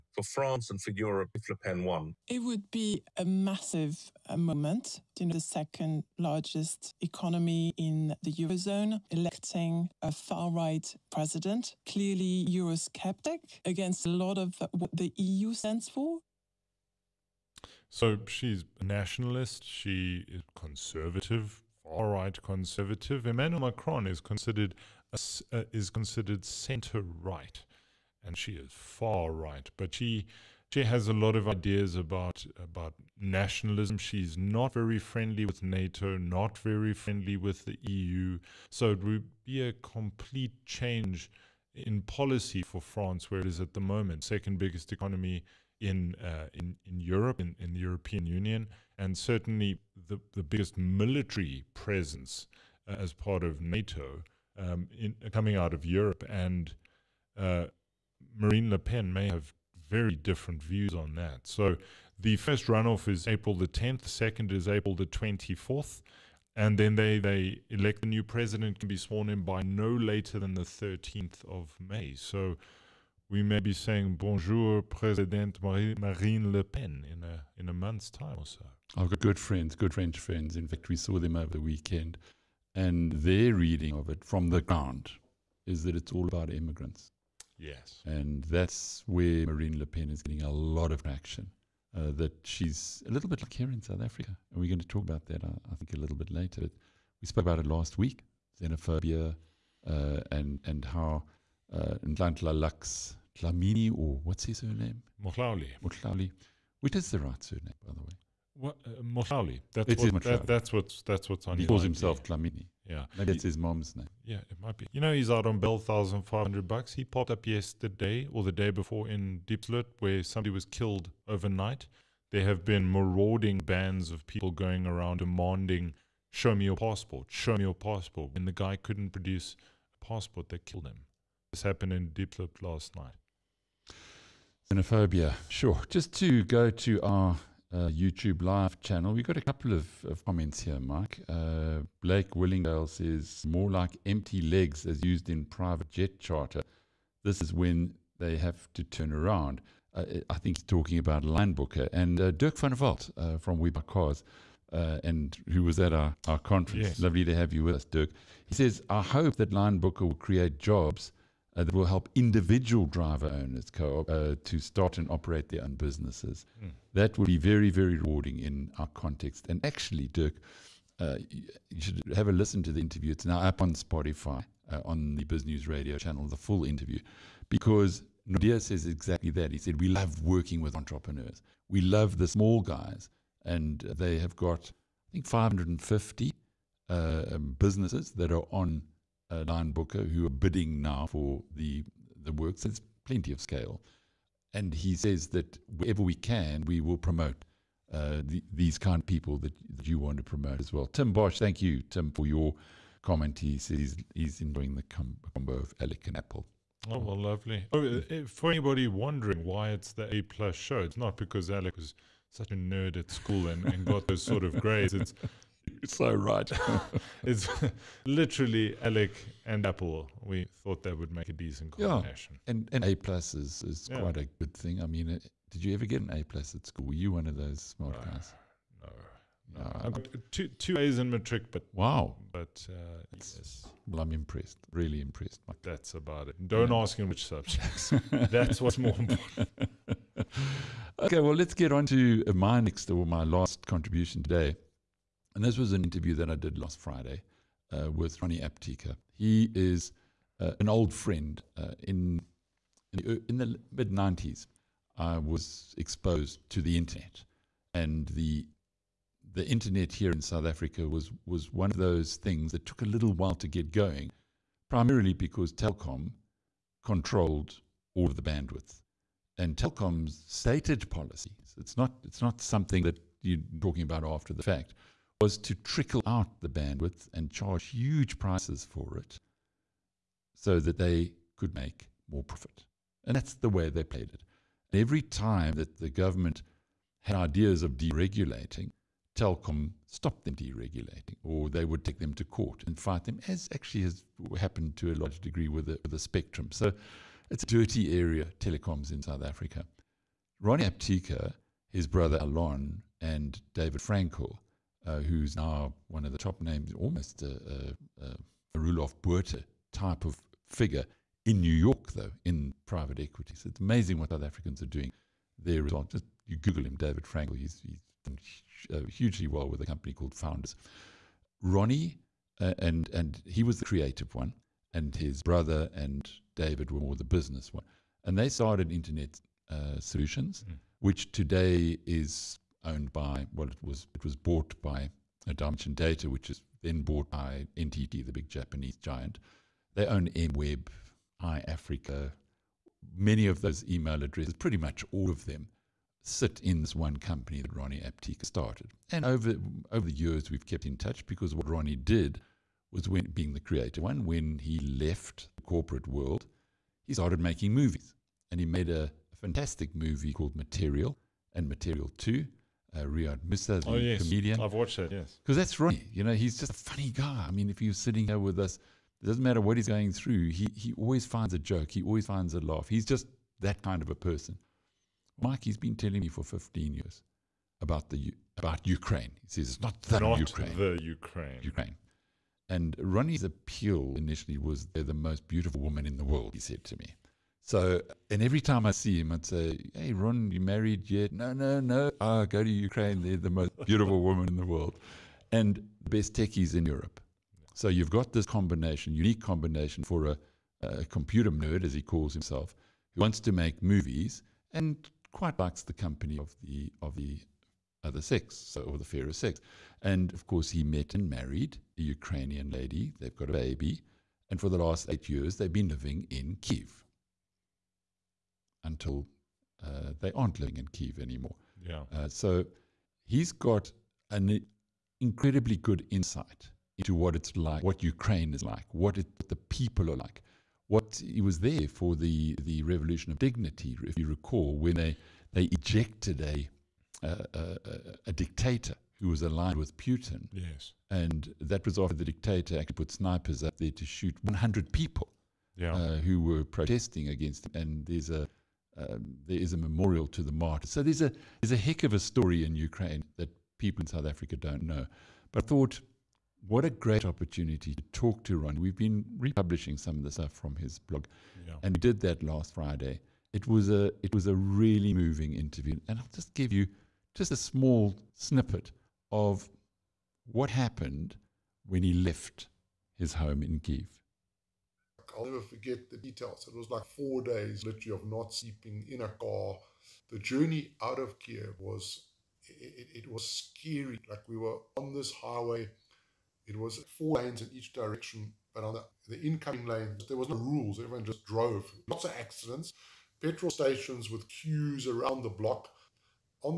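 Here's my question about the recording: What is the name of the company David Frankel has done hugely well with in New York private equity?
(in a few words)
Founders.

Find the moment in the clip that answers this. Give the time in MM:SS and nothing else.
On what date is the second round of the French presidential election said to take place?
01:04.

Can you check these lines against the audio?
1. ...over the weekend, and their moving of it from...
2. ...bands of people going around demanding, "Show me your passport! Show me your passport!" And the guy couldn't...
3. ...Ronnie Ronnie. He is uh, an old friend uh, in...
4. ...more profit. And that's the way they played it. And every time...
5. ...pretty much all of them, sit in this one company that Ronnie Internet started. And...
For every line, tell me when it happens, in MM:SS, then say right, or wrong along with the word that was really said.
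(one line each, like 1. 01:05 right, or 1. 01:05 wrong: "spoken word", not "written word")
1. 01:21 wrong: "reading", not "moving"
2. 02:03 right
3. 04:08 wrong: "Apteker", not "Ronnie"
4. 04:42 right
5. 05:44 wrong: "Apteker", not "Internet".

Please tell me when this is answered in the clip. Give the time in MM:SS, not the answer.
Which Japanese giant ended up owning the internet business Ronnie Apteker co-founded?
05:37.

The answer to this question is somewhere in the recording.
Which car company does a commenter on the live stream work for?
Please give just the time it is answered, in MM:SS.
02:33.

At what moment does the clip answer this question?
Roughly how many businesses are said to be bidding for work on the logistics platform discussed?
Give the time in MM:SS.
03:05.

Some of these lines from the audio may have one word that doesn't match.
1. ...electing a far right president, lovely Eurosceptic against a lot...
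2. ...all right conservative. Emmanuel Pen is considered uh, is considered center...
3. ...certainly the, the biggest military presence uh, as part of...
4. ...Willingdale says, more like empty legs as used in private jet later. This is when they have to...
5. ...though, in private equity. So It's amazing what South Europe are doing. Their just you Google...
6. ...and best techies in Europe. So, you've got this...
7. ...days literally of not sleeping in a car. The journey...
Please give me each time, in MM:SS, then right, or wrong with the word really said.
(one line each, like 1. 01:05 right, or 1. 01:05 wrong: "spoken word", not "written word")
1. 00:09 wrong: "clearly", not "lovely"
2. 00:21 wrong: "Macron", not "Pen"
3. 00:49 right
4. 02:22 wrong: "charter", not "later"
5. 05:11 wrong: "Africans", not "Europe"
6. 06:35 right
7. 07:57 right.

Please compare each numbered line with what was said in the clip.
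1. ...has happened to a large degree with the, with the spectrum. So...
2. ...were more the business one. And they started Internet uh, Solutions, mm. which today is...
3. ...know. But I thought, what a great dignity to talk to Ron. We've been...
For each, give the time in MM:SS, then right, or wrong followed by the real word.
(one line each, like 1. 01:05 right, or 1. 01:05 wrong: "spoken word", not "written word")
1. 04:53 right
2. 05:26 right
3. 07:34 wrong: "opportunity", not "dignity".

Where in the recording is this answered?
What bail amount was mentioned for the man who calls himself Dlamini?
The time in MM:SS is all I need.
01:55.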